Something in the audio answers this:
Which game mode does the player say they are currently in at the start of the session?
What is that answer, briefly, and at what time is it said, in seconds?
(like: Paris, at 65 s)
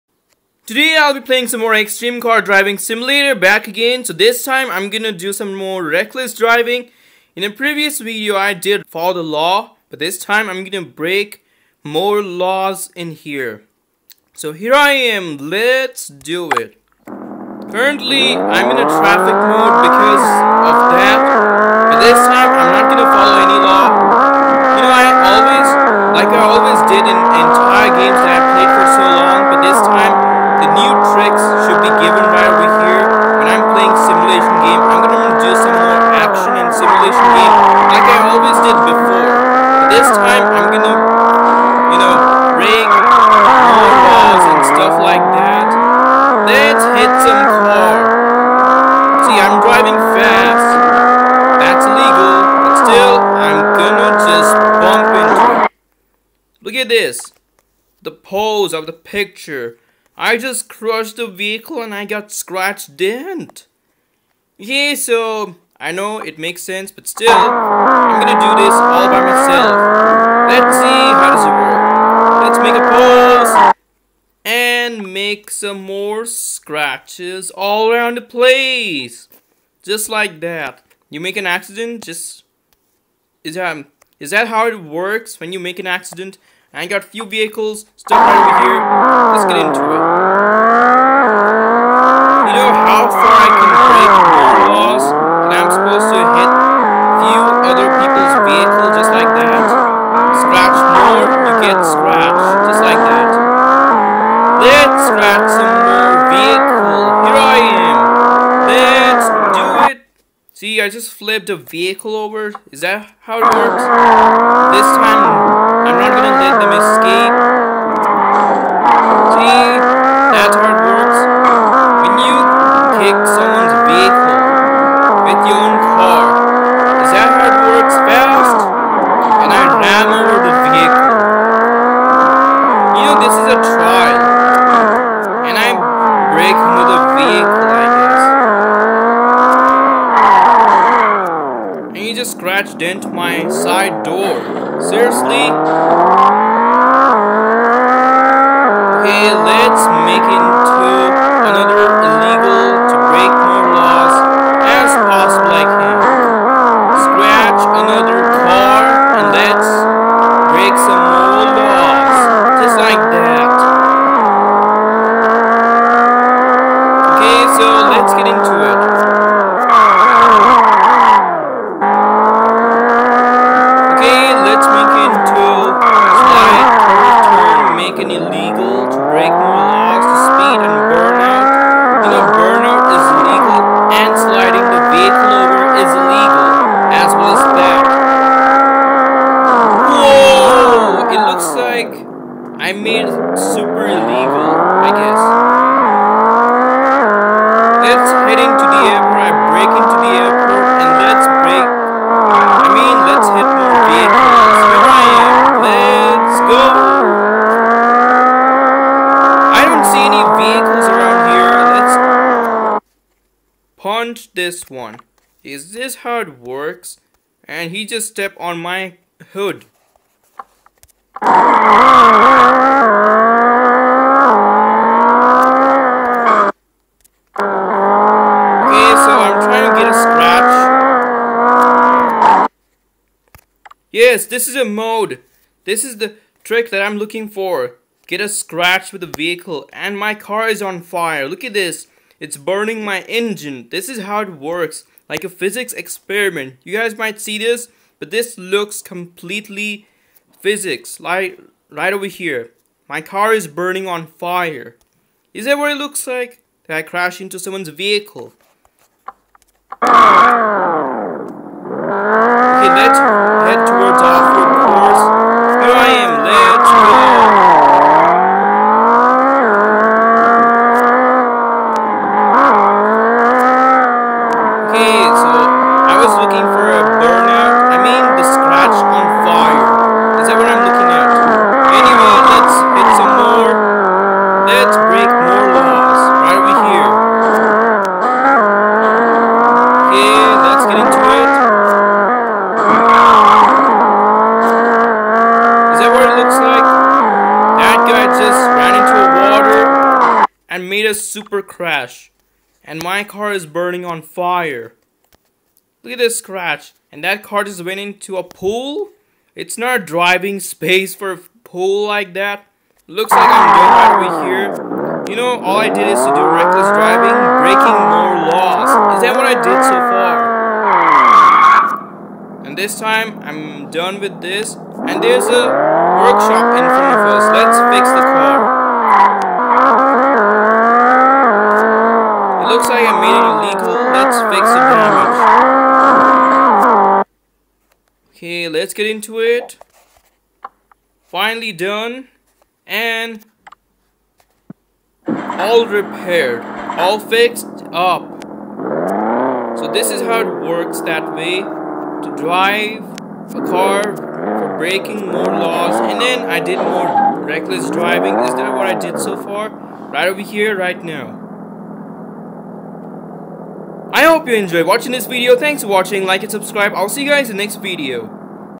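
traffic mode, at 18 s.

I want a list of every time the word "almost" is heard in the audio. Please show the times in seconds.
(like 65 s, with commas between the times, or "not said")
not said.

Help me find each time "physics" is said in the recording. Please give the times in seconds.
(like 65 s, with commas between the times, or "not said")
245 s, 250 s.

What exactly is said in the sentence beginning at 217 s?
And he just stepped on my hood.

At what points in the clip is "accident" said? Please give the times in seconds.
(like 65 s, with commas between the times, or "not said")
81 s, 85 s.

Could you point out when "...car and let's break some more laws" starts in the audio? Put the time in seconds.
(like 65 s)
158 s.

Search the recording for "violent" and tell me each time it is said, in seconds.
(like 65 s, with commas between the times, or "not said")
not said.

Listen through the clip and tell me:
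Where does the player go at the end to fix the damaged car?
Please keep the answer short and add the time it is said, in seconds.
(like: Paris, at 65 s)
a workshop, at 325 s.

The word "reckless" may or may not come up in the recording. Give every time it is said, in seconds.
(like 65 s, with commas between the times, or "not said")
5 s, 316 s, 357 s.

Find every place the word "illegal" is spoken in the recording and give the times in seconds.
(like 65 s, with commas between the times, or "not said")
51 s, 152 s, 178 s, 333 s.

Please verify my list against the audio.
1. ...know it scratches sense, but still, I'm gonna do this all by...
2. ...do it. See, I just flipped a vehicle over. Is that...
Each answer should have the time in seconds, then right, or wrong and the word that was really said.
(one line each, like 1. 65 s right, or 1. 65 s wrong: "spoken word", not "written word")
1. 65 s wrong: "makes", not "scratches"
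2. 109 s right.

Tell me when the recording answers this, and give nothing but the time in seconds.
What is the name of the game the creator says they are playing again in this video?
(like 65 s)
1 s.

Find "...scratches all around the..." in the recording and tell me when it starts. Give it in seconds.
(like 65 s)
76 s.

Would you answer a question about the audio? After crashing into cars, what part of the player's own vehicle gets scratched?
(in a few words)
side door.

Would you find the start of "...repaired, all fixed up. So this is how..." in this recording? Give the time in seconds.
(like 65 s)
345 s.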